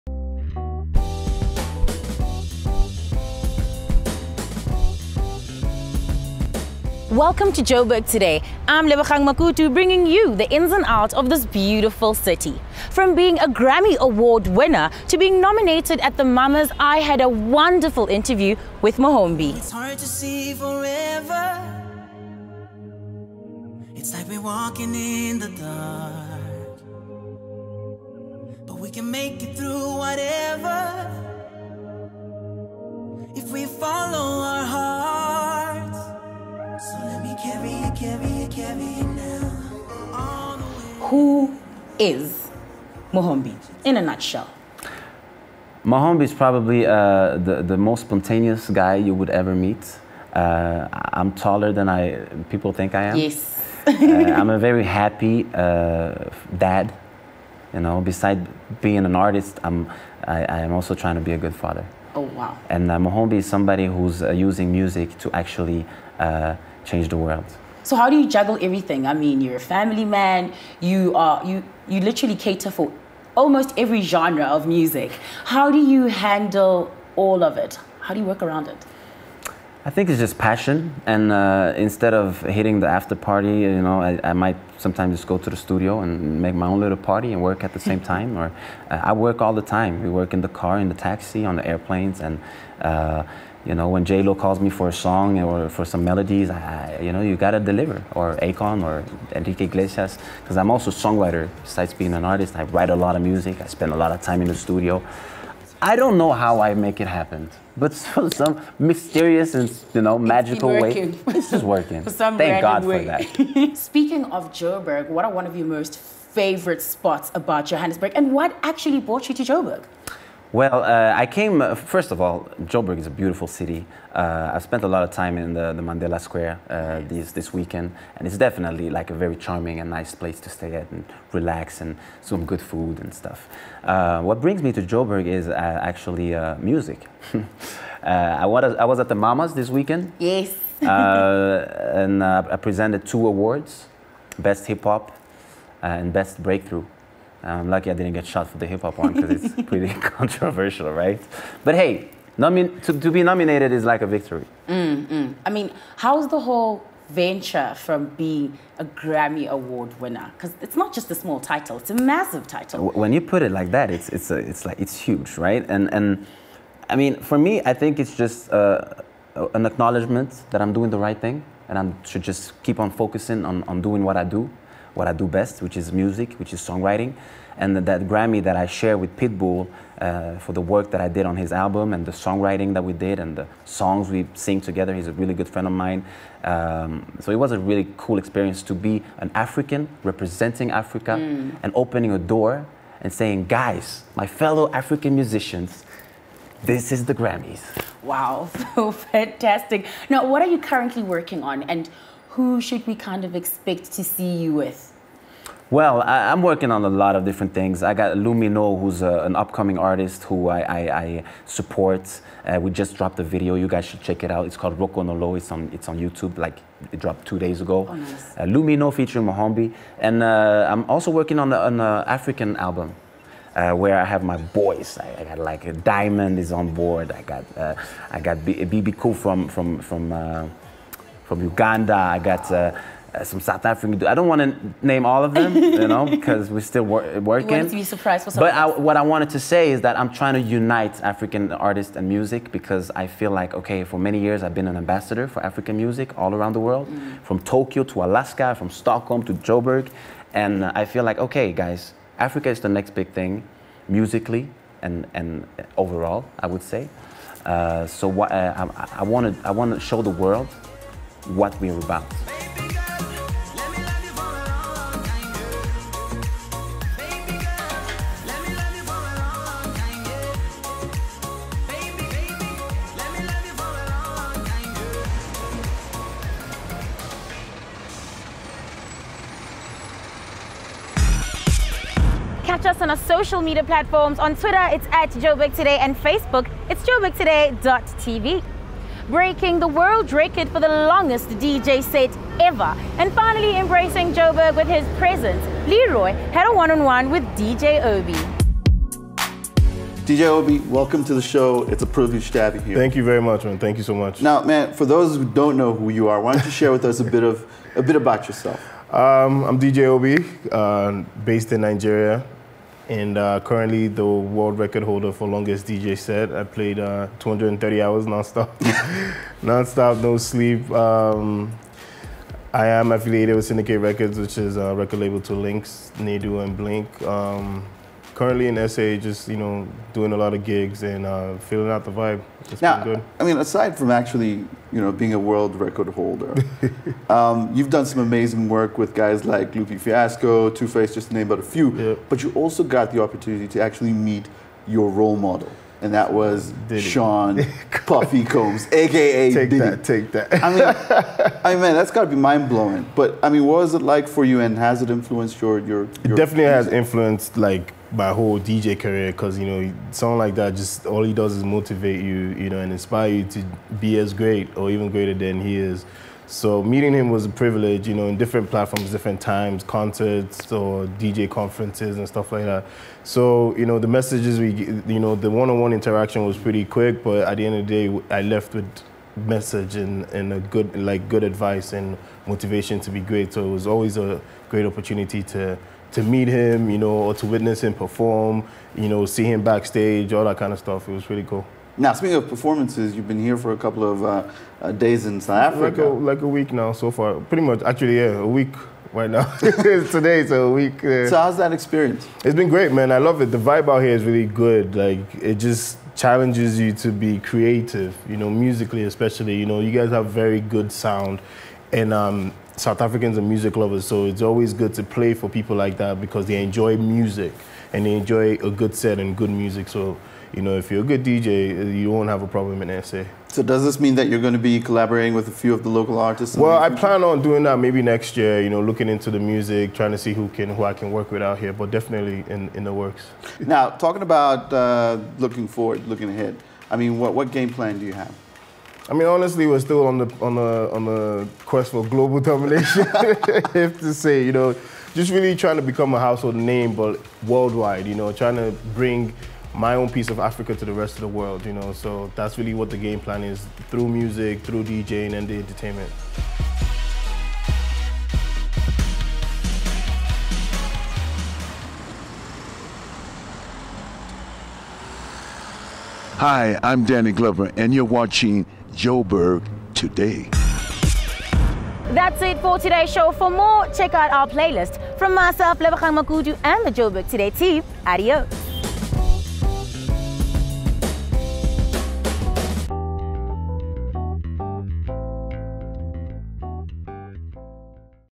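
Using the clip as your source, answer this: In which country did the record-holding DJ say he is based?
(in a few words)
Nigeria.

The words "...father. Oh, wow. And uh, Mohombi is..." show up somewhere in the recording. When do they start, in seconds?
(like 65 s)
61 s.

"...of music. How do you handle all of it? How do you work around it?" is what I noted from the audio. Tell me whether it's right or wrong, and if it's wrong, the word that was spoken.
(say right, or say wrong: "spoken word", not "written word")
right.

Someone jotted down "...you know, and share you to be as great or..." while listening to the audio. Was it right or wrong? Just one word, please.
wrong.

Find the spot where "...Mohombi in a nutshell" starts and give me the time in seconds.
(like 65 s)
43 s.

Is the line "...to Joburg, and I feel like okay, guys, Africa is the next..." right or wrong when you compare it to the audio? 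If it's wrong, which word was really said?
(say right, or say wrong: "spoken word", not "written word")
right.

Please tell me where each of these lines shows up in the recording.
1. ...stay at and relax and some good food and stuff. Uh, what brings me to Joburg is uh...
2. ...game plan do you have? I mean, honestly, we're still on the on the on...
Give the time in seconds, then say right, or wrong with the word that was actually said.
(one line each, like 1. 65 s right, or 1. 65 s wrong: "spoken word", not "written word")
1. 130 s right
2. 437 s right.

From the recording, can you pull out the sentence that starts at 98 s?
Or Akon or Enrique Iglesias, because I'm also a songwriter.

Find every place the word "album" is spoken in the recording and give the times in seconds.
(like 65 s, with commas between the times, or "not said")
181 s, 222 s.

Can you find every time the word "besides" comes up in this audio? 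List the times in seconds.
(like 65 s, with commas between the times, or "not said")
57 s, 101 s.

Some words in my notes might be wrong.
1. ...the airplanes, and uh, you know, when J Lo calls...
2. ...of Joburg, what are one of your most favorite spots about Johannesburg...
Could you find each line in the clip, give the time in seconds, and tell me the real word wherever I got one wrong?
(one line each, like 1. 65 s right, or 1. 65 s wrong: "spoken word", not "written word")
1. 91 s right
2. 114 s right.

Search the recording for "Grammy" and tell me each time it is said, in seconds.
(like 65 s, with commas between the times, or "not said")
13 s, 158 s, 178 s, 197 s.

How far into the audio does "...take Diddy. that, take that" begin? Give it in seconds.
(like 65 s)
349 s.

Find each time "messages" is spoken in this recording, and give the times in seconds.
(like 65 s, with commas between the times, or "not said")
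373 s, 379 s.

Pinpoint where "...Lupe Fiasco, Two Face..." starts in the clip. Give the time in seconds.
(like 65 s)
339 s.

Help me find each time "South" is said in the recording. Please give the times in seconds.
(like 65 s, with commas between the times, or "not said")
233 s, 395 s, 412 s.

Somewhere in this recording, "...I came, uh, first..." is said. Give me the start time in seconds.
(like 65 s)
121 s.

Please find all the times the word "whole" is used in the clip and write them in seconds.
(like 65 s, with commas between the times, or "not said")
156 s, 358 s.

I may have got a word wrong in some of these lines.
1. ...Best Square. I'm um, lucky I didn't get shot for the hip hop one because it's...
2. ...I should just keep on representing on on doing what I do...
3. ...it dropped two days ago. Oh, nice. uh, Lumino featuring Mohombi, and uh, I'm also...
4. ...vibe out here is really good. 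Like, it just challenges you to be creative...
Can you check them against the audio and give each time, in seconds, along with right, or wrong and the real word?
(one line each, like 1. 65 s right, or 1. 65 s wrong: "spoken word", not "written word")
1. 146 s wrong: "Breakthrough", not "Square"
2. 171 s wrong: "focusing", not "representing"
3. 216 s right
4. 403 s right.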